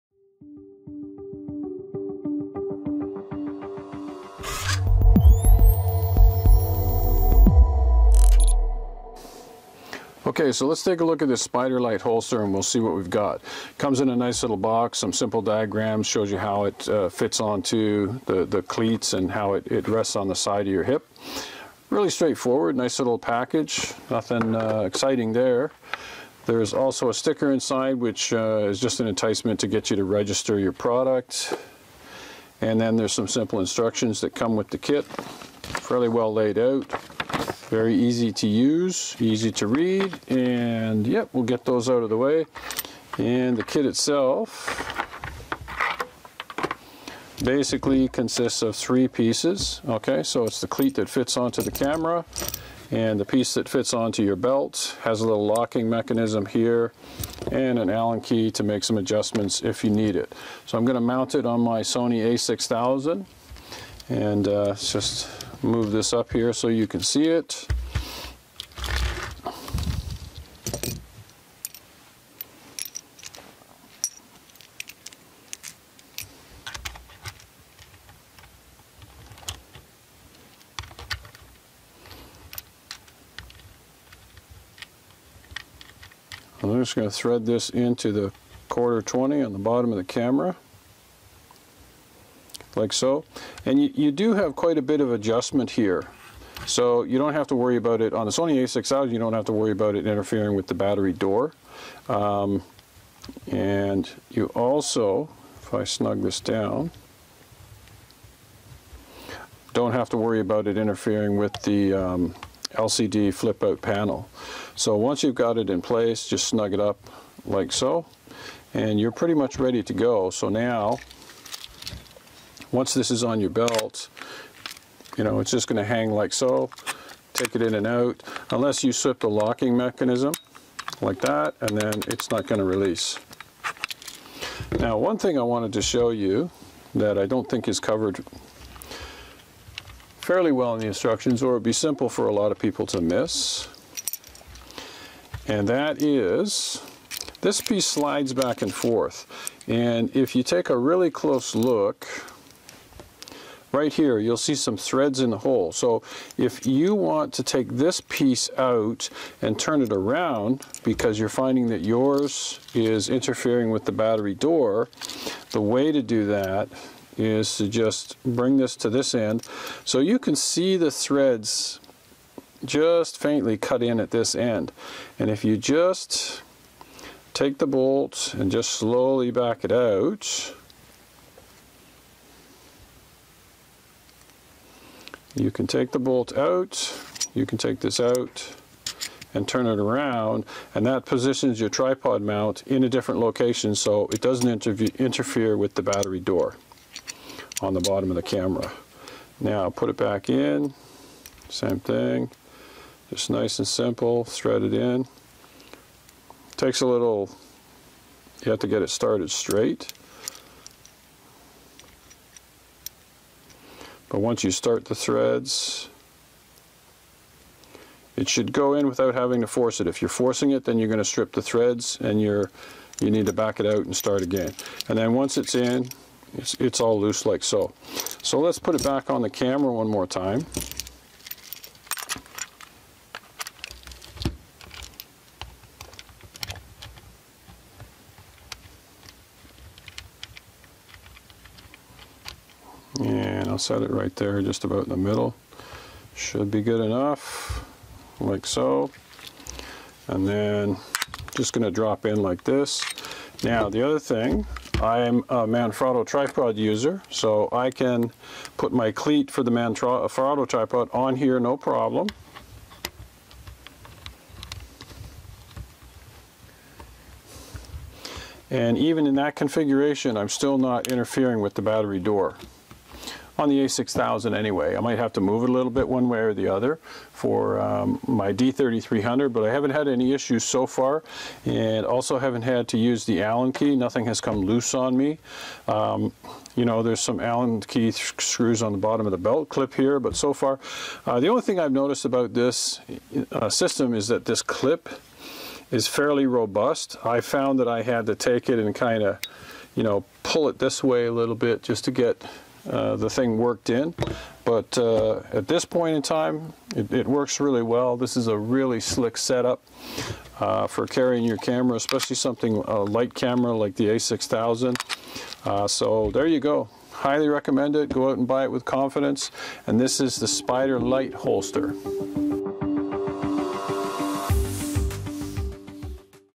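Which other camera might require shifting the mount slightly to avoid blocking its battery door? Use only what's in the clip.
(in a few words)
D3300.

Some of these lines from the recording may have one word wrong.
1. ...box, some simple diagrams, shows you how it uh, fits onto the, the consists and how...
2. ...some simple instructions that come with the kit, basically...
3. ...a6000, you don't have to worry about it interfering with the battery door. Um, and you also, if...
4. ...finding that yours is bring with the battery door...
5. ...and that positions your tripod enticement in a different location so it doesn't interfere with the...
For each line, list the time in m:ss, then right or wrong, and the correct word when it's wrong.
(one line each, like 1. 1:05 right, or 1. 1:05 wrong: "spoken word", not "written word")
1. 0:14 wrong: "cleats", not "consists"
2. 0:33 wrong: "fairly", not "basically"
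3. 1:38 right
4. 2:41 wrong: "interfering", not "bring"
5. 3:10 wrong: "mount", not "enticement".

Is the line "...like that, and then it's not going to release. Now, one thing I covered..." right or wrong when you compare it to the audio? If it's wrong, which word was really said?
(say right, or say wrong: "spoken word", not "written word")
wrong: "wanted", not "covered".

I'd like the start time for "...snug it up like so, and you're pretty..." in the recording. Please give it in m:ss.
1:56.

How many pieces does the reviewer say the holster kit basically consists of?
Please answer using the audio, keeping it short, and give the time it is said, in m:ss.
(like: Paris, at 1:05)
3, at 0:48.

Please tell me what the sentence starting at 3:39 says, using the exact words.
If you're forcing it, then you're going to strip the threads and you're, you need to back it out and start again.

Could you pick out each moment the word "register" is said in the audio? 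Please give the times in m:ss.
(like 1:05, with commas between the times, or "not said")
0:30.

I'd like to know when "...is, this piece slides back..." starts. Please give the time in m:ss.
2:26.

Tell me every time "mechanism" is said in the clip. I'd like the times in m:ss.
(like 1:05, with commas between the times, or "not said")
0:55, 2:09.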